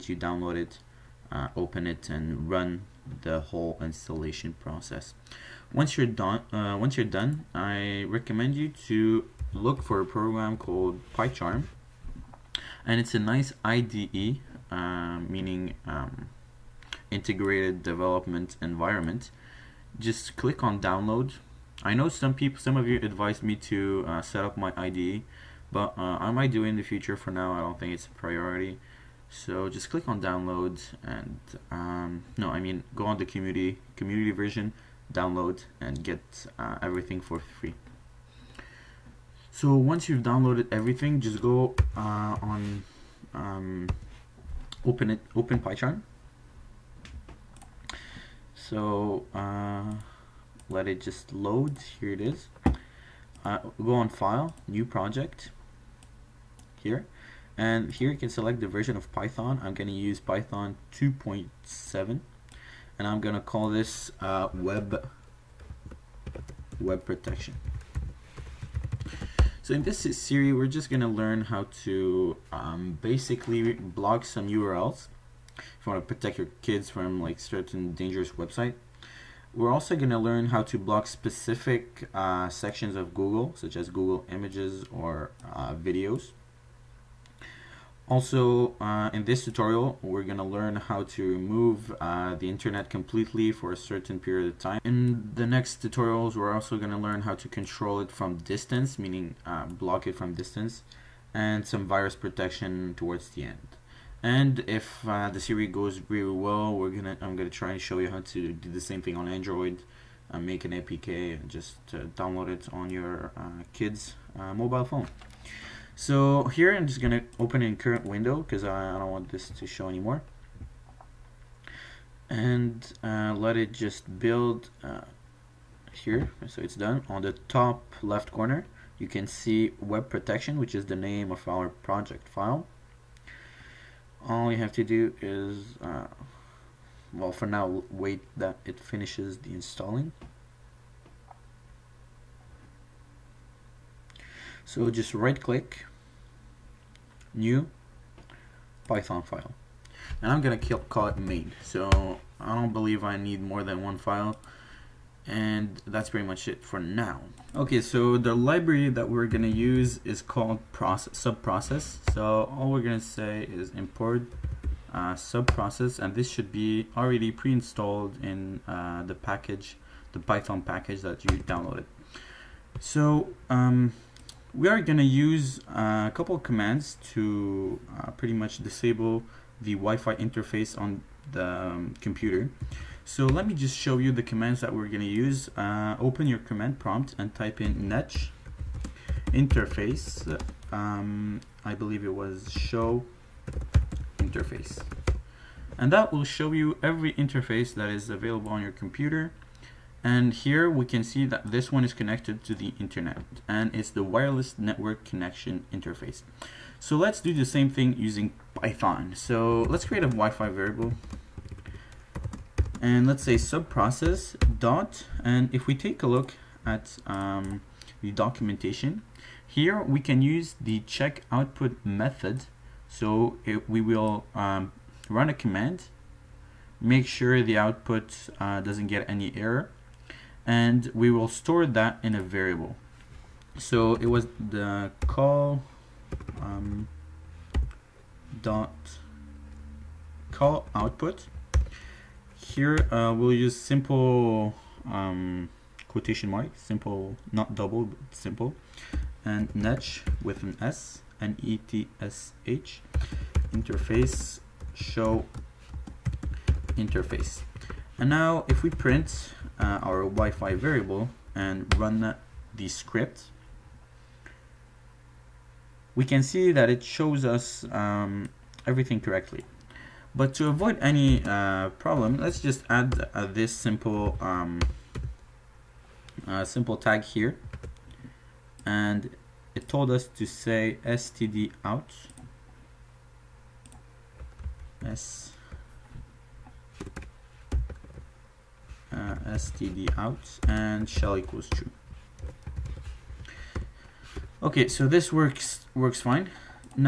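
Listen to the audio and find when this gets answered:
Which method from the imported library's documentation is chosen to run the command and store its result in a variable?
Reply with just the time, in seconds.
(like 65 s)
220 s.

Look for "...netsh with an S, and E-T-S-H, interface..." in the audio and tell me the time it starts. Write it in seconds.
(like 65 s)
249 s.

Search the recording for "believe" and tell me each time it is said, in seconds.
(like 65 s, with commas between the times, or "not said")
152 s, 191 s.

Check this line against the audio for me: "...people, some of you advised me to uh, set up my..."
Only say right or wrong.
right.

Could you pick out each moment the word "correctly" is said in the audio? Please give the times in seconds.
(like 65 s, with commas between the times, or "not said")
269 s.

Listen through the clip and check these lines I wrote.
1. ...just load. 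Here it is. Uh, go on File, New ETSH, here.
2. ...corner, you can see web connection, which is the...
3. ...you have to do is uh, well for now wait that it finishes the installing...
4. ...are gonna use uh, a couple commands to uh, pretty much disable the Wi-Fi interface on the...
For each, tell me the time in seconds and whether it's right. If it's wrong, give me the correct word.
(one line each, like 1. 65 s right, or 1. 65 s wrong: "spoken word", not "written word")
1. 51 s wrong: "Project", not "ETSH"
2. 128 s wrong: "protection", not "connection"
3. 134 s right
4. 174 s right.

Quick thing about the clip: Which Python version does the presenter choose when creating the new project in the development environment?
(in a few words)
Python 2.7.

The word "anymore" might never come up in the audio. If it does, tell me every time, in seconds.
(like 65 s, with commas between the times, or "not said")
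119 s.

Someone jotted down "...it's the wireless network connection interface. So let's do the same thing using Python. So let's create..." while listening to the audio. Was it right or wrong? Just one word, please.
right.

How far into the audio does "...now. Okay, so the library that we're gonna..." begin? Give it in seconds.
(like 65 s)
156 s.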